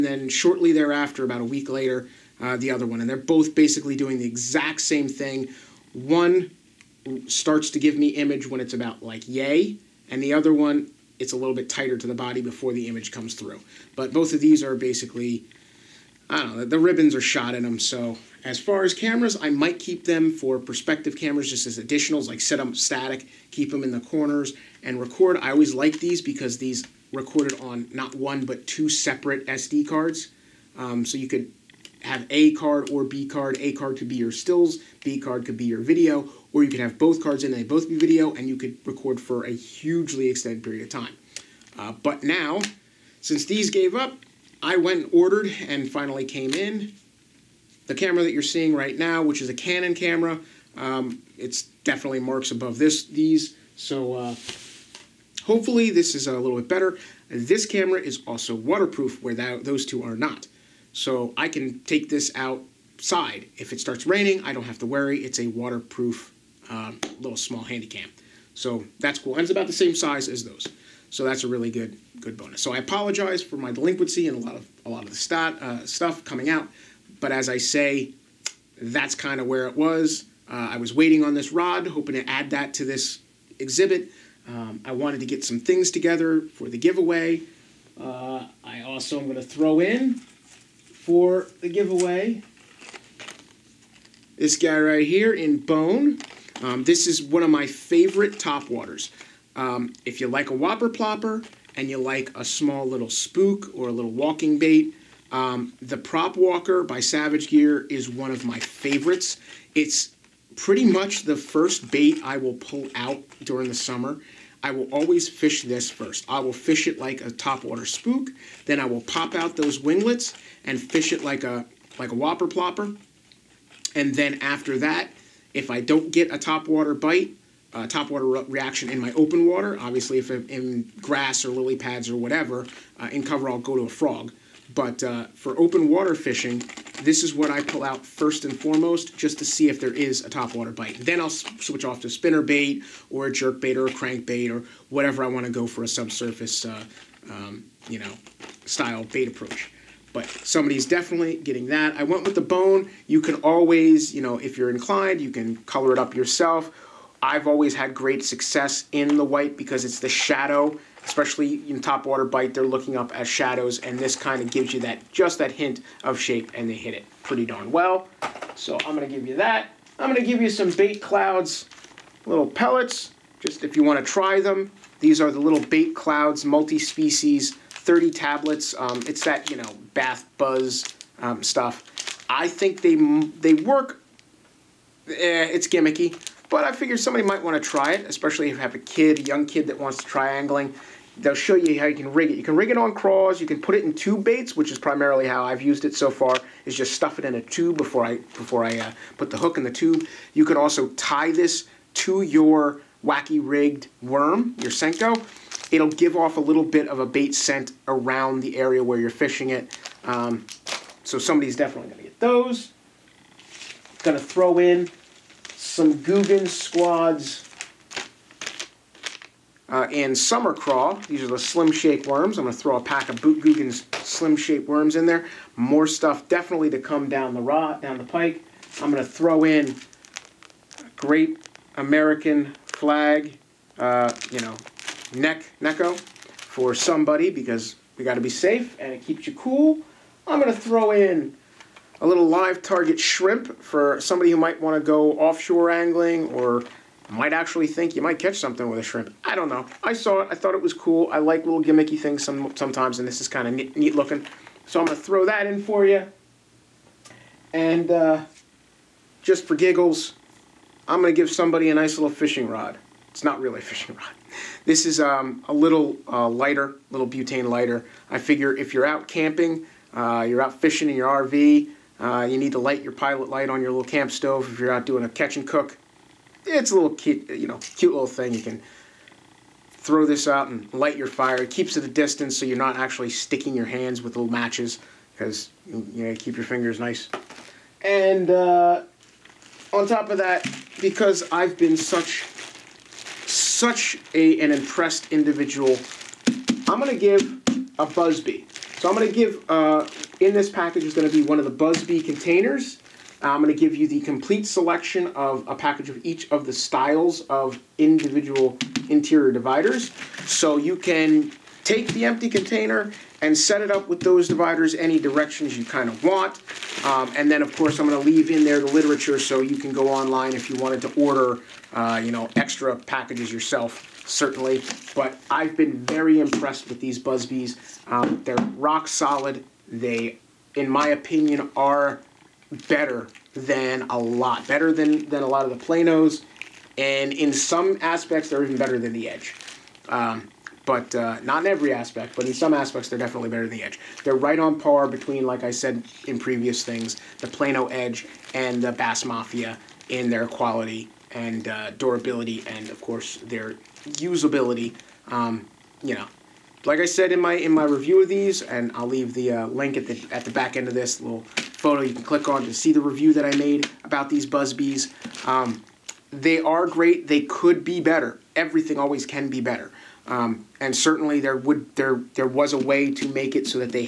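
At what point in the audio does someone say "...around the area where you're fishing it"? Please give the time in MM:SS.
03:27.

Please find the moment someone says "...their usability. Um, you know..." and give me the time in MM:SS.
05:53.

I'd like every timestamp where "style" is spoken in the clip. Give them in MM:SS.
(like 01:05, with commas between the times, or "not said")
02:28, 05:06.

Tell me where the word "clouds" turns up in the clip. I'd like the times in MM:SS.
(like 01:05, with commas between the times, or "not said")
02:51, 02:55.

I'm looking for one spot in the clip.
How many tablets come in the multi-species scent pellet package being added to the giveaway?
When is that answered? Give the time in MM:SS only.
02:57.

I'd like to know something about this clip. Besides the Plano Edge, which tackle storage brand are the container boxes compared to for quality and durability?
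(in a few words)
Bass Mafia.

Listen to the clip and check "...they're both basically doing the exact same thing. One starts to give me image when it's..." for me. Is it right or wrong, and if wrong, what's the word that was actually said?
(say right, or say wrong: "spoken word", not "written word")
right.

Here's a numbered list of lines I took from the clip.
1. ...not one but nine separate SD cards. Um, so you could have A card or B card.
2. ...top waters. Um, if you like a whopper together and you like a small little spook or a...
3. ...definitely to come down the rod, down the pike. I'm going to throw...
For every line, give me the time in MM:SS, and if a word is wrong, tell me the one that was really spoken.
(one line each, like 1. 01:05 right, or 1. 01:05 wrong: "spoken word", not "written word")
1. 00:27 wrong: "two", not "nine"
2. 01:38 wrong: "plopper", not "together"
3. 03:46 right.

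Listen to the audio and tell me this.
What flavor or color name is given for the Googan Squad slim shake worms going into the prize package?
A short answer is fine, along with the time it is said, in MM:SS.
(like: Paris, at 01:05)
summer craw, at 03:40.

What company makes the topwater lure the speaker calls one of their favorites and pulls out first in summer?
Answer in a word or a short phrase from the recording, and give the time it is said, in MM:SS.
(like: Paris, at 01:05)
Savage Gear, at 01:47.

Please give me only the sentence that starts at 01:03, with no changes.
If it starts raining, I don't have to worry.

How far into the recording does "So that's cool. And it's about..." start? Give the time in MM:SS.
01:08.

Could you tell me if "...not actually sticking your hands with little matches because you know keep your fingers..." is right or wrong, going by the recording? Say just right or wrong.
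right.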